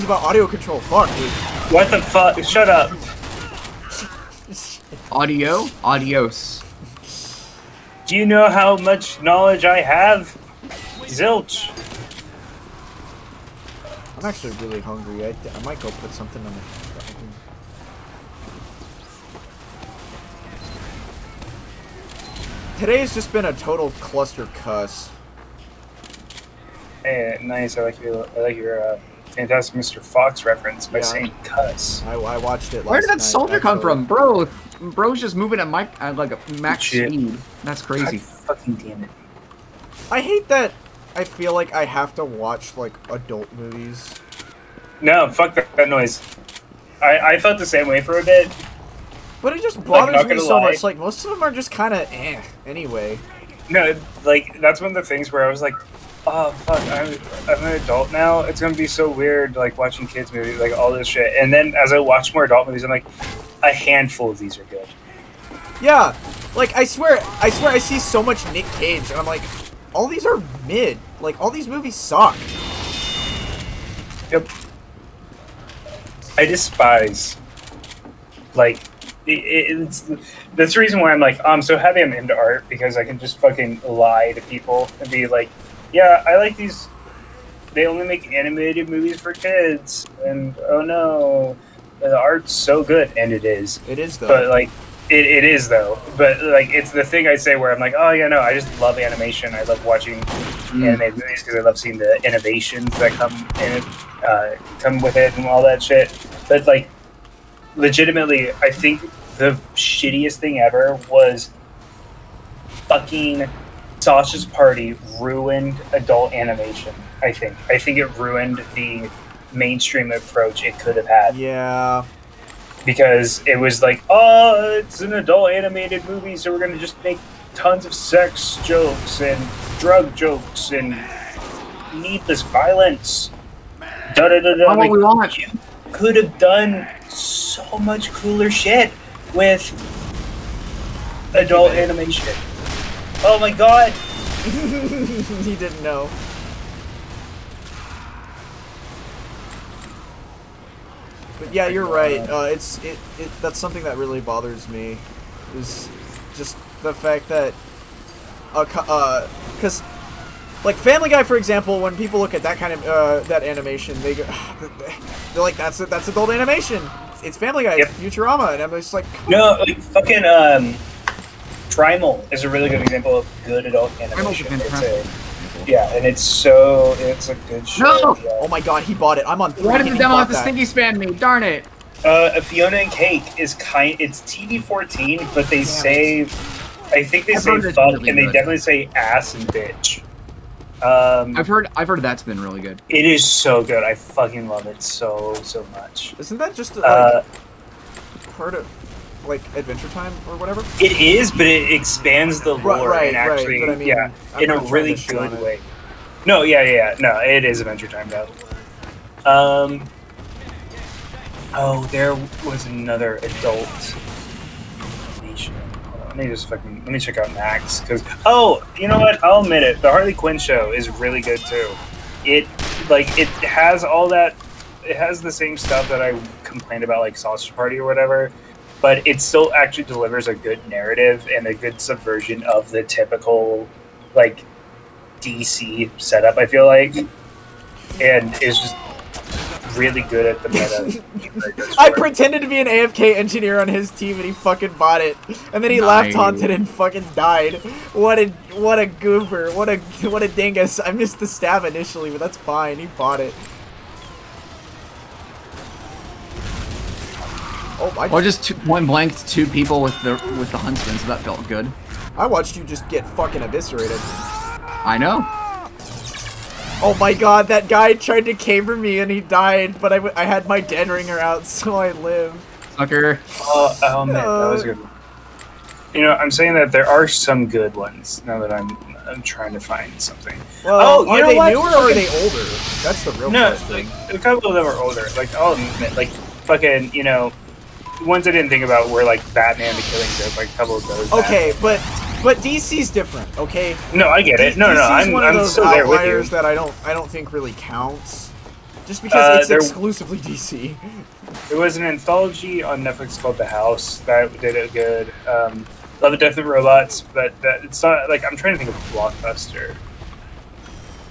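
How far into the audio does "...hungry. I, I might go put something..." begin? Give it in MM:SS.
00:14.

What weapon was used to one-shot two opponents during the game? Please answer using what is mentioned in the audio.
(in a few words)
huntsman.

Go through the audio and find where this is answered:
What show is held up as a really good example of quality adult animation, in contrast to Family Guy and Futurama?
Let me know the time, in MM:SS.
02:51.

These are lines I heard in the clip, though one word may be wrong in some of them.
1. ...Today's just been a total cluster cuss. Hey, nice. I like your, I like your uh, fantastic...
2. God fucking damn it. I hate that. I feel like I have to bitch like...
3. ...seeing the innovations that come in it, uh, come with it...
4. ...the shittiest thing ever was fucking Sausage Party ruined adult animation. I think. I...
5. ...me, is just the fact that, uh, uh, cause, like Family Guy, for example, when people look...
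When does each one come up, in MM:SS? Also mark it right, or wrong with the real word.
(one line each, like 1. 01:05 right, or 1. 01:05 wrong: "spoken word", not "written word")
1. 00:22 right
2. 00:38 wrong: "watch", not "bitch"
3. 01:41 right
4. 01:49 right
5. 02:34 right.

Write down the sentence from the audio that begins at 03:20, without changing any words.
It is, but it expands the lore right, and actually right, I mean, yeah I'm in a really good way.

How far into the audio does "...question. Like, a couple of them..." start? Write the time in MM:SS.
04:43.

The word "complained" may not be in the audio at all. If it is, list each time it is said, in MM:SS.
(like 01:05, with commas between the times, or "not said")
03:46.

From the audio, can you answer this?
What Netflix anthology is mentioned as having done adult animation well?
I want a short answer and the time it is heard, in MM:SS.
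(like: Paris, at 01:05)
The House, at 05:03.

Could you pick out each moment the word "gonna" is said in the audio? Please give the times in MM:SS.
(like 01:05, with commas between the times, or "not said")
00:58, 02:06.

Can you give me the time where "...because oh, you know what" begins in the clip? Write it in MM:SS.
03:37.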